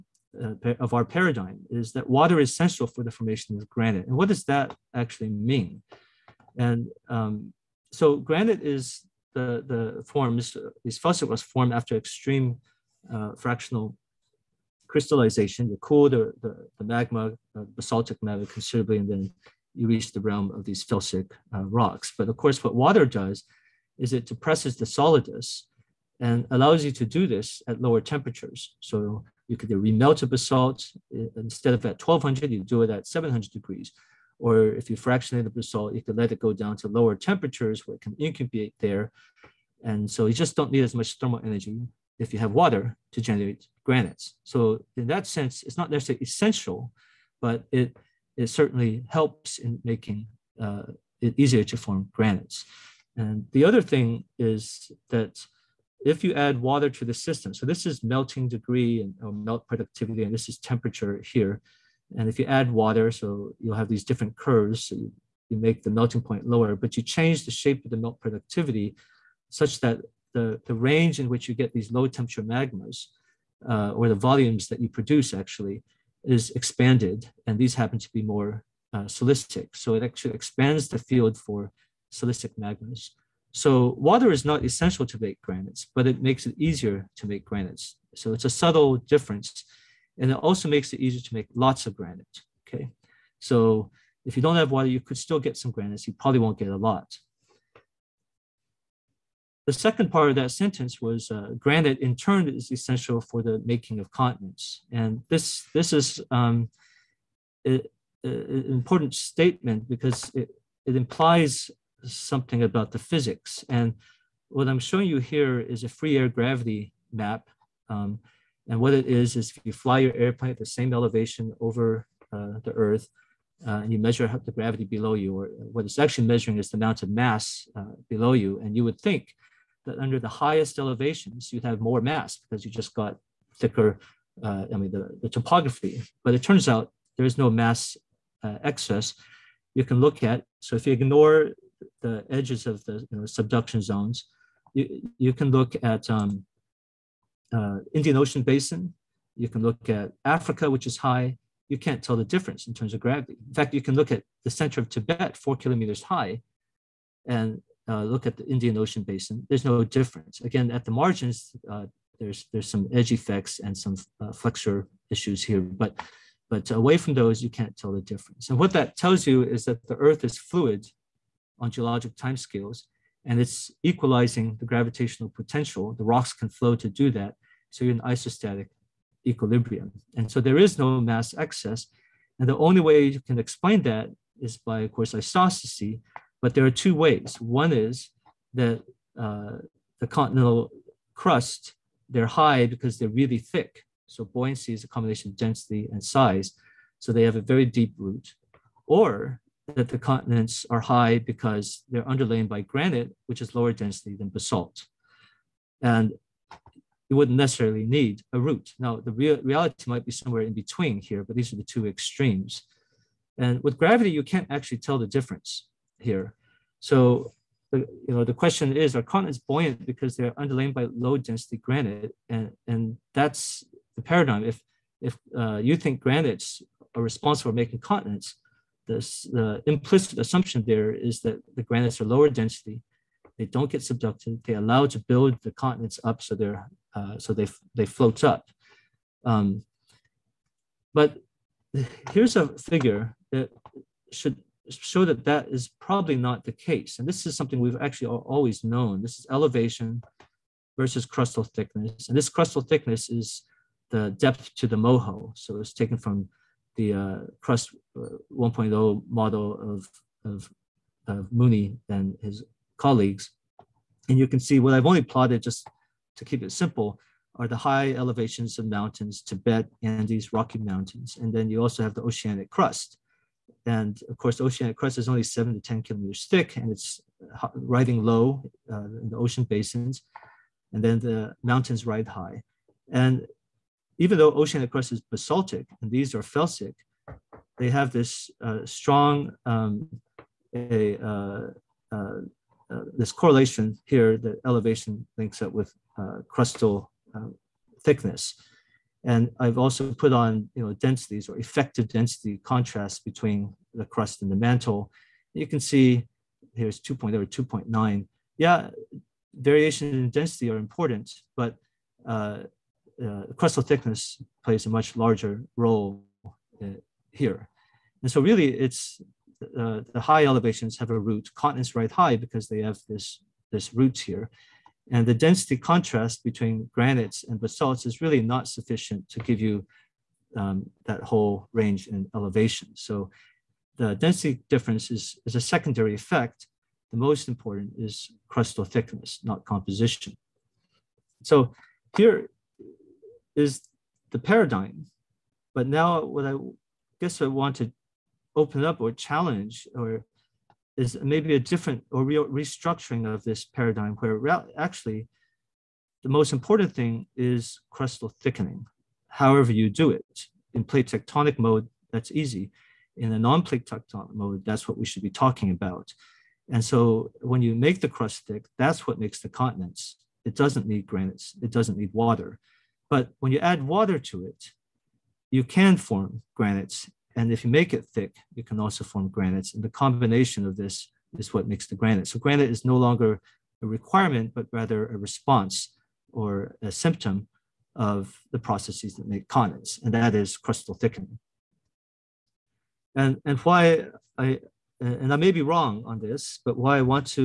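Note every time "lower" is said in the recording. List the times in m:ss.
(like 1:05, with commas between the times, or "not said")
0:27, 0:36, 1:06, 3:23, 3:52.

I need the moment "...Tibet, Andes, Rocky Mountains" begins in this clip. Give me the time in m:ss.
4:29.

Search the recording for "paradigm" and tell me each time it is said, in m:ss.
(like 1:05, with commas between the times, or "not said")
0:01, 3:44, 5:44, 5:53.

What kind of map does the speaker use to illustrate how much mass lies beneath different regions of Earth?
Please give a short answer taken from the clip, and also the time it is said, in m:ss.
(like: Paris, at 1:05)
free air gravity map, at 1:55.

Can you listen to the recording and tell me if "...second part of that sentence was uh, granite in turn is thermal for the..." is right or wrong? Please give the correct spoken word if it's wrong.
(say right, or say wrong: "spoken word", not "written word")
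wrong: "essential", not "thermal".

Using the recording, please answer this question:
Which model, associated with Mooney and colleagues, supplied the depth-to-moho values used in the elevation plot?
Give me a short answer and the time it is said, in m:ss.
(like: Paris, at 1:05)
crust 1.0, at 4:17.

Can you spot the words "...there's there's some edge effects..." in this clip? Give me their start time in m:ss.
2:42.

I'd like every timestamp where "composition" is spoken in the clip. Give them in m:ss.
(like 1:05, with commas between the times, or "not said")
5:39.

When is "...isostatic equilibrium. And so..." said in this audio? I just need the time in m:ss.
2:57.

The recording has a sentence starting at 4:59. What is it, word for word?
And I've also put on you know densities or effective density contrast between the crust and the mantle.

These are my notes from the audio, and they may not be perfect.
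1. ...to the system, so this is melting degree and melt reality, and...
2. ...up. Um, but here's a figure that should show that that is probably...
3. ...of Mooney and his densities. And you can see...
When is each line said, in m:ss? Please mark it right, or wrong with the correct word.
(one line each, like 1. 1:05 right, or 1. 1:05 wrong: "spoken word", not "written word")
1. 0:56 wrong: "productivity", not "reality"
2. 3:58 right
3. 4:21 wrong: "colleagues", not "densities".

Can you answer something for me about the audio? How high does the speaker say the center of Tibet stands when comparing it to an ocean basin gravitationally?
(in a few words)
4 kilometers.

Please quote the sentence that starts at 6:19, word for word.
And the combination of this is what makes the granite.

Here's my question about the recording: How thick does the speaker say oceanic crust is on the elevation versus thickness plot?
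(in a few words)
7 to 10 kilometers.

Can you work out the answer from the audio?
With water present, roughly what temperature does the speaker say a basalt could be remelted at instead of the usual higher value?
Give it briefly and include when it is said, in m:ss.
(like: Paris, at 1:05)
700 degrees, at 0:33.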